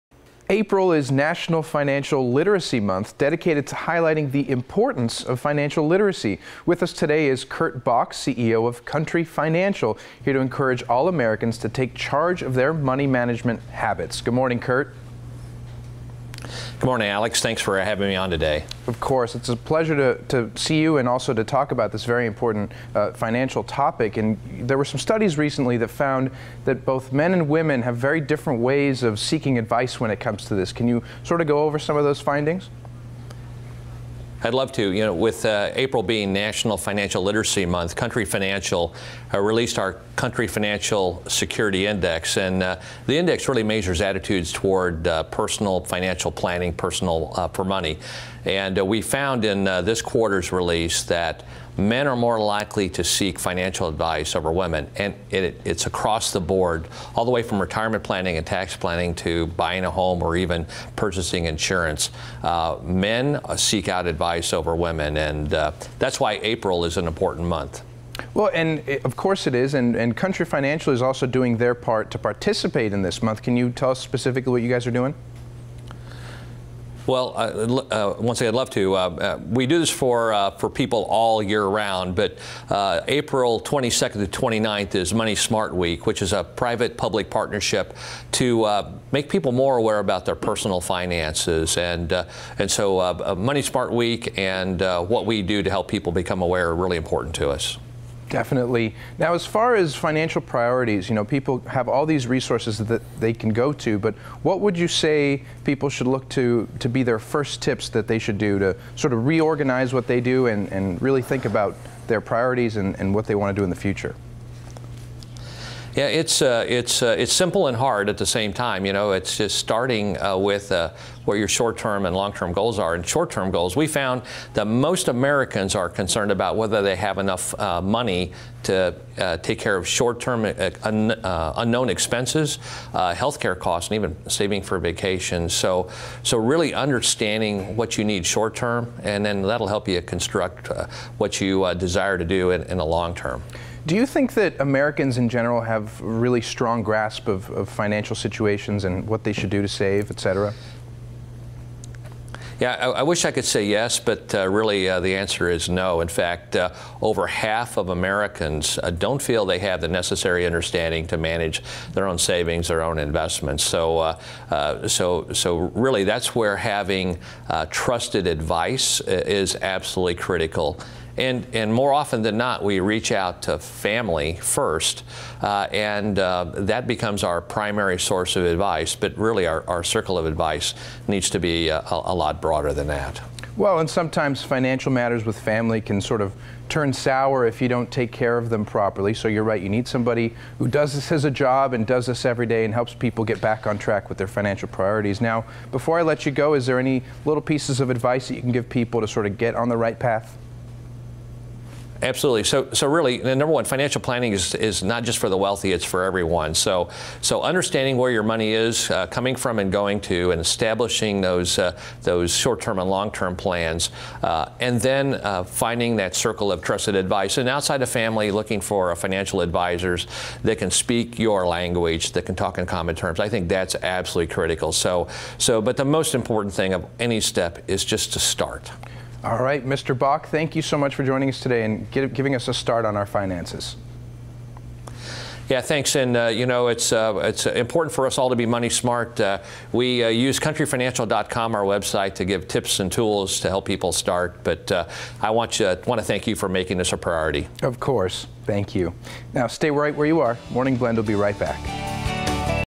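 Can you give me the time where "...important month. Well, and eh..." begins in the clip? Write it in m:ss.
1:07.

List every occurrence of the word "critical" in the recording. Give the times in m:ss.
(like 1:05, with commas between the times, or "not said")
2:50, 3:44.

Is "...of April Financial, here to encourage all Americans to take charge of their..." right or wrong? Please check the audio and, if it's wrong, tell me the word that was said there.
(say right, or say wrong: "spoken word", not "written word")
wrong: "Country", not "April".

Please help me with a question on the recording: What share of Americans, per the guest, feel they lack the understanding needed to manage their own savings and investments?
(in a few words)
over half.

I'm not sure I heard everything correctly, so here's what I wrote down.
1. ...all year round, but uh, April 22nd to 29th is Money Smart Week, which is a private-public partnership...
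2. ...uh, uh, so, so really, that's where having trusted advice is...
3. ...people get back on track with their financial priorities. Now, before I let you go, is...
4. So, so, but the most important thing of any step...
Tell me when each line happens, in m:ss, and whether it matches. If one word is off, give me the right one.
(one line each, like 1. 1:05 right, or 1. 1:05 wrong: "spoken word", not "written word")
1. 1:21 right
2. 2:43 right
3. 3:12 right
4. 3:44 right.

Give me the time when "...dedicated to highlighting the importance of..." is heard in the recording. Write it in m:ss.
0:03.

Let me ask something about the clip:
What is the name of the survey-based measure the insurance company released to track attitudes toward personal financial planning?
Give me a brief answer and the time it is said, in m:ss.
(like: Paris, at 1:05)
Country Financial Security Index, at 0:40.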